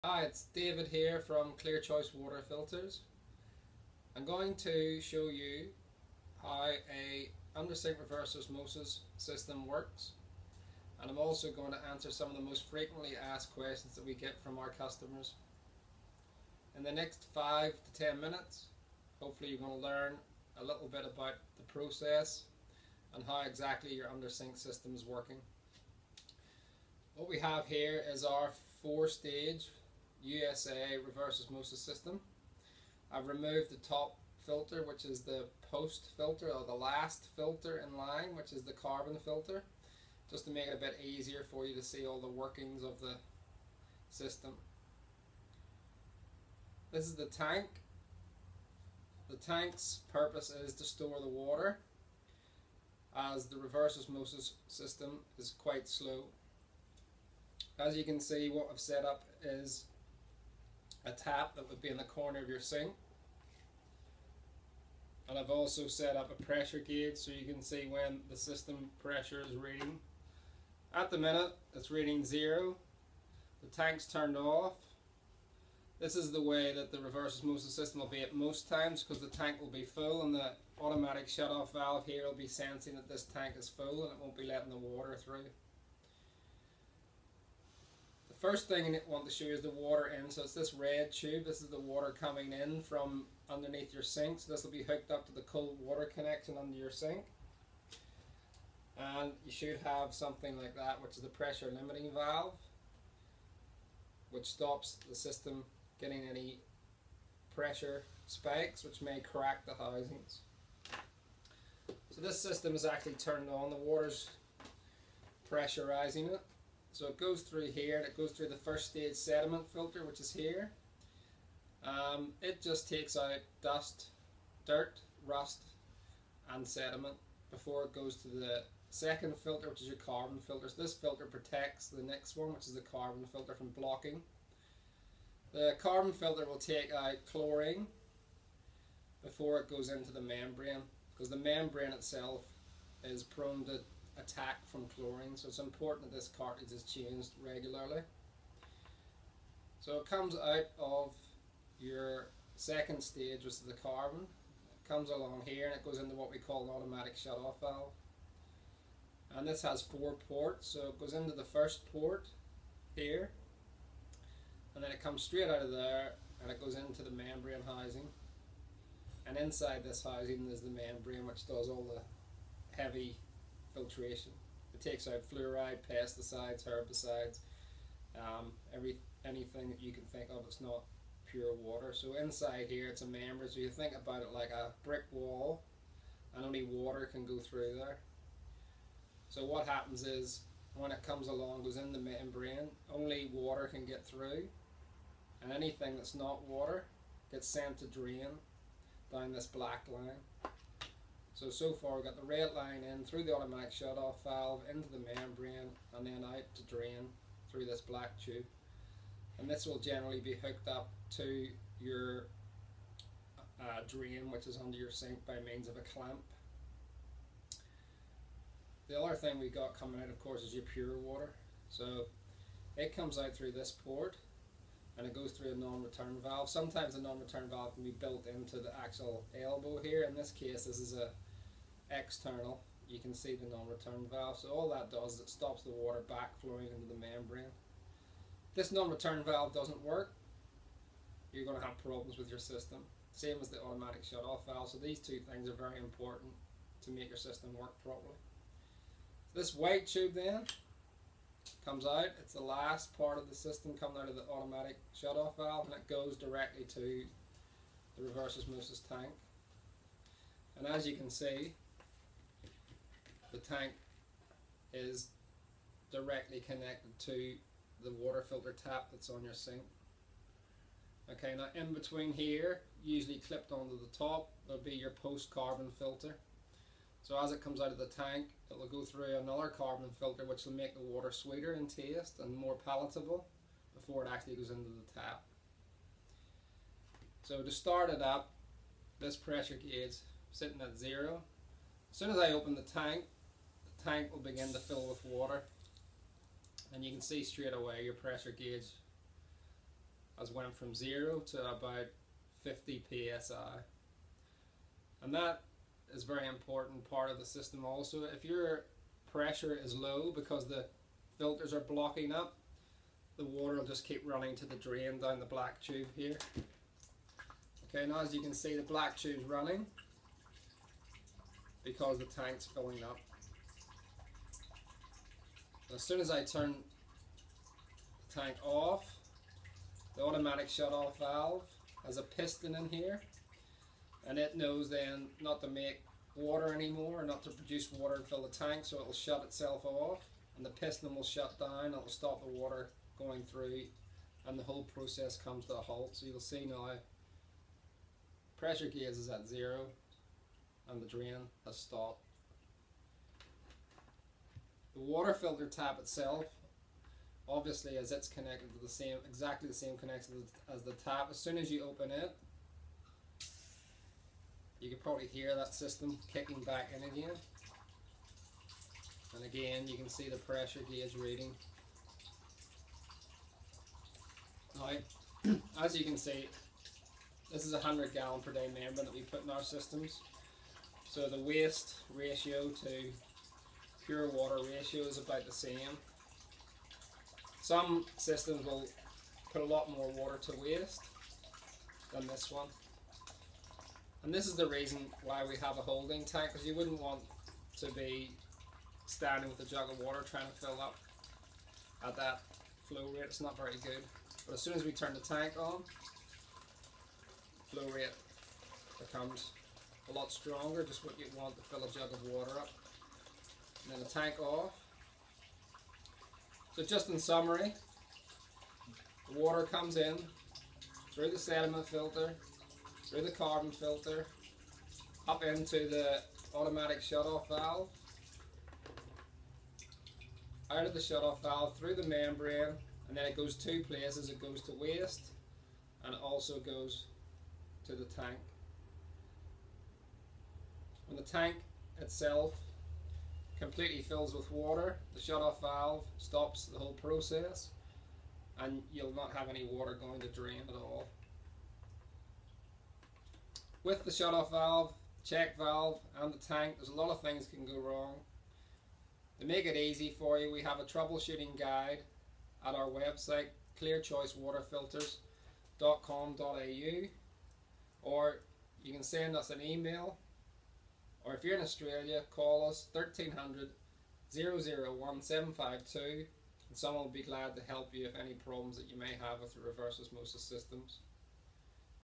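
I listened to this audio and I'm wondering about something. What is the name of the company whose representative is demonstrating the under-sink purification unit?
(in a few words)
Clear Choice Water Filters.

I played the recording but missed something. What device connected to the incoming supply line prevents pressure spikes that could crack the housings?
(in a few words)
pressure limiting valve.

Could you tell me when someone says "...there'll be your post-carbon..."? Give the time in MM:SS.
04:34.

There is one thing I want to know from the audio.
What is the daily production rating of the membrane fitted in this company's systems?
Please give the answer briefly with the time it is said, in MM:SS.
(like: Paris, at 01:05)
100 gallons per day, at 06:17.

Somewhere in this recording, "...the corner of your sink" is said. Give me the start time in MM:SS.
01:01.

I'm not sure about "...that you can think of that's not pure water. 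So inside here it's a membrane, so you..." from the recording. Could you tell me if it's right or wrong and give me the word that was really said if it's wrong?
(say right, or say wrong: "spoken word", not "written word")
right.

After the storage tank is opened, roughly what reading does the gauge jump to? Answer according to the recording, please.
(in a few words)
50 psi.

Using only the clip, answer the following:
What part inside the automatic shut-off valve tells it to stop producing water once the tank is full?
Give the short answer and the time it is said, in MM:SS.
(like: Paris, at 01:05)
a piston, at 05:31.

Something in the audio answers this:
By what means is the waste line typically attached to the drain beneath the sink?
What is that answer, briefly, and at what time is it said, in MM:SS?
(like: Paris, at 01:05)
a clamp, at 03:35.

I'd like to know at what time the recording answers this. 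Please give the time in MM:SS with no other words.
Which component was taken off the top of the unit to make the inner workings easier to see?
00:35.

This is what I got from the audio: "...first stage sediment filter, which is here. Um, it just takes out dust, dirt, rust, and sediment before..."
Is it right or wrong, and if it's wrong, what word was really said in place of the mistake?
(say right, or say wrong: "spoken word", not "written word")
right.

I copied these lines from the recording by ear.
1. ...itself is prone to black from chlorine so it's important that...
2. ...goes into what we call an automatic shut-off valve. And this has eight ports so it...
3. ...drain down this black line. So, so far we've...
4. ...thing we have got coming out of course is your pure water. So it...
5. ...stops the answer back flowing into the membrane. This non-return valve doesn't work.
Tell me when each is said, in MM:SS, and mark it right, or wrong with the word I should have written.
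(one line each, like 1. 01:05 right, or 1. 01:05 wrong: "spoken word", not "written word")
1. 02:21 wrong: "attack", not "black"
2. 02:35 wrong: "four", not "eight"
3. 03:17 right
4. 03:39 right
5. 03:55 wrong: "water", not "answer".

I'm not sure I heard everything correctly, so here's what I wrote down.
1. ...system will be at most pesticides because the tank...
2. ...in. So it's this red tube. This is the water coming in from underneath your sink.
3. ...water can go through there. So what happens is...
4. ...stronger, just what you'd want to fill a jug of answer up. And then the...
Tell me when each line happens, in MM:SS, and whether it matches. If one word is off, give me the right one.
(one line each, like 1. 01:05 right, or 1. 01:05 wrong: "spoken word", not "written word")
1. 01:17 wrong: "times", not "pesticides"
2. 01:30 right
3. 03:06 right
4. 06:50 wrong: "water", not "answer".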